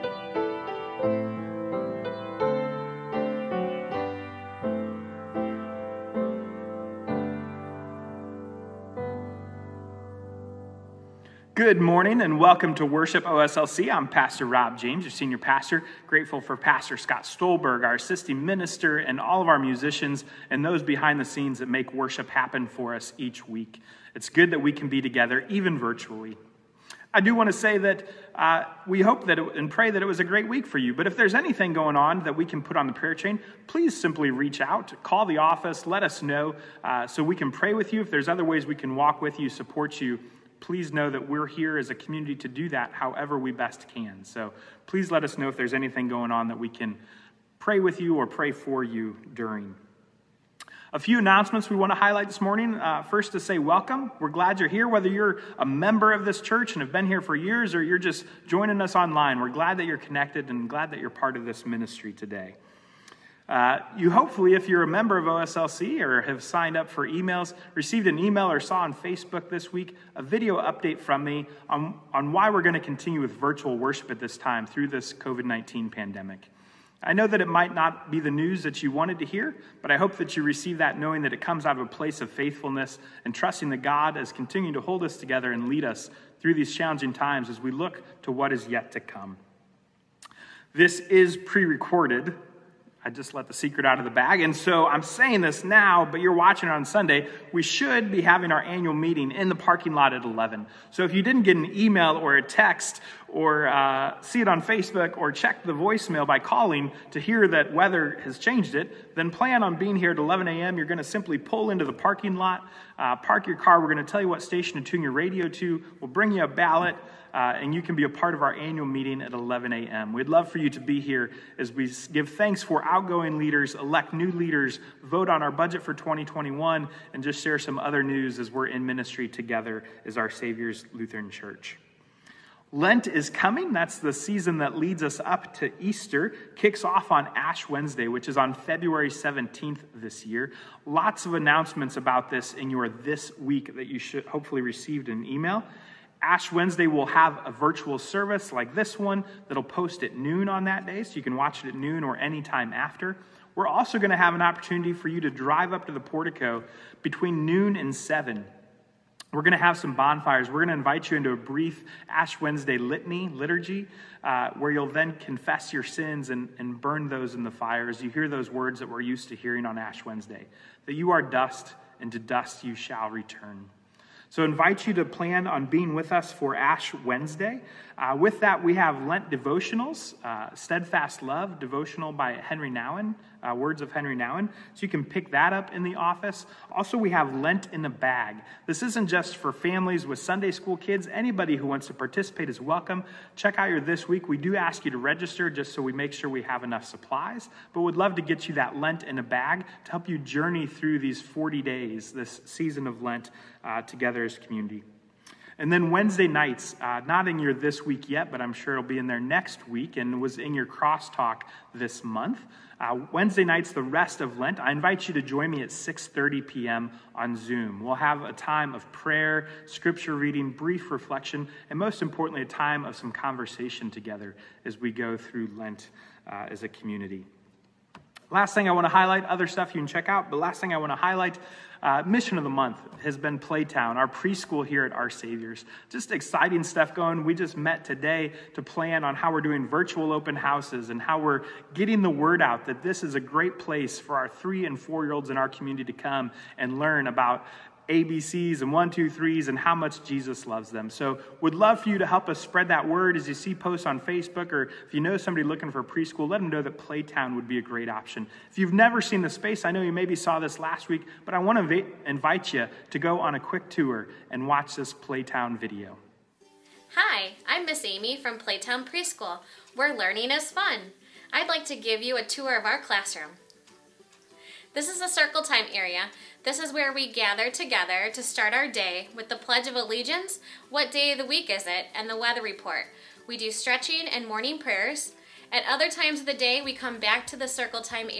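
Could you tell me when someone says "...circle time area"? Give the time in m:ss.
4:35.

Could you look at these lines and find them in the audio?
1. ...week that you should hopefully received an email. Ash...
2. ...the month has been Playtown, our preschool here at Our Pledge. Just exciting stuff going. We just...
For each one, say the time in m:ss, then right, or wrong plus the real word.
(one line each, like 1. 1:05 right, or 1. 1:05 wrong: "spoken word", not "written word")
1. 2:23 right
2. 3:52 wrong: "Saviors", not "Pledge".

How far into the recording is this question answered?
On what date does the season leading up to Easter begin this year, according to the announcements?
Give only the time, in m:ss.
2:18.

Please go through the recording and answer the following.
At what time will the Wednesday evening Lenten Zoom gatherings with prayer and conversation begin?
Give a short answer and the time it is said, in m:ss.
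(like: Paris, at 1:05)
6:30 p.m., at 3:35.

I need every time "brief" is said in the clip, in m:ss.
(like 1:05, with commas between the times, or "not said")
2:41, 3:40.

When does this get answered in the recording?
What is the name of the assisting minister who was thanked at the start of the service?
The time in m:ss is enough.
0:16.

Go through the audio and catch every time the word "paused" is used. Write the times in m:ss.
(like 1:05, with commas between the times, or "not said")
not said.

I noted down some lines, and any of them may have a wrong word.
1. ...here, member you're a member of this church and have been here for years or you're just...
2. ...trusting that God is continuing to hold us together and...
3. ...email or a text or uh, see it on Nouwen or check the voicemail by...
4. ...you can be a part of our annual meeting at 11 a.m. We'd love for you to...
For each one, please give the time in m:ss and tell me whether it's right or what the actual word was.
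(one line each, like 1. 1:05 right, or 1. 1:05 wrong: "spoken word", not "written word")
1. 0:54 wrong: "whether", not "member"
2. 1:23 right
3. 1:41 wrong: "Facebook", not "Nouwen"
4. 1:57 right.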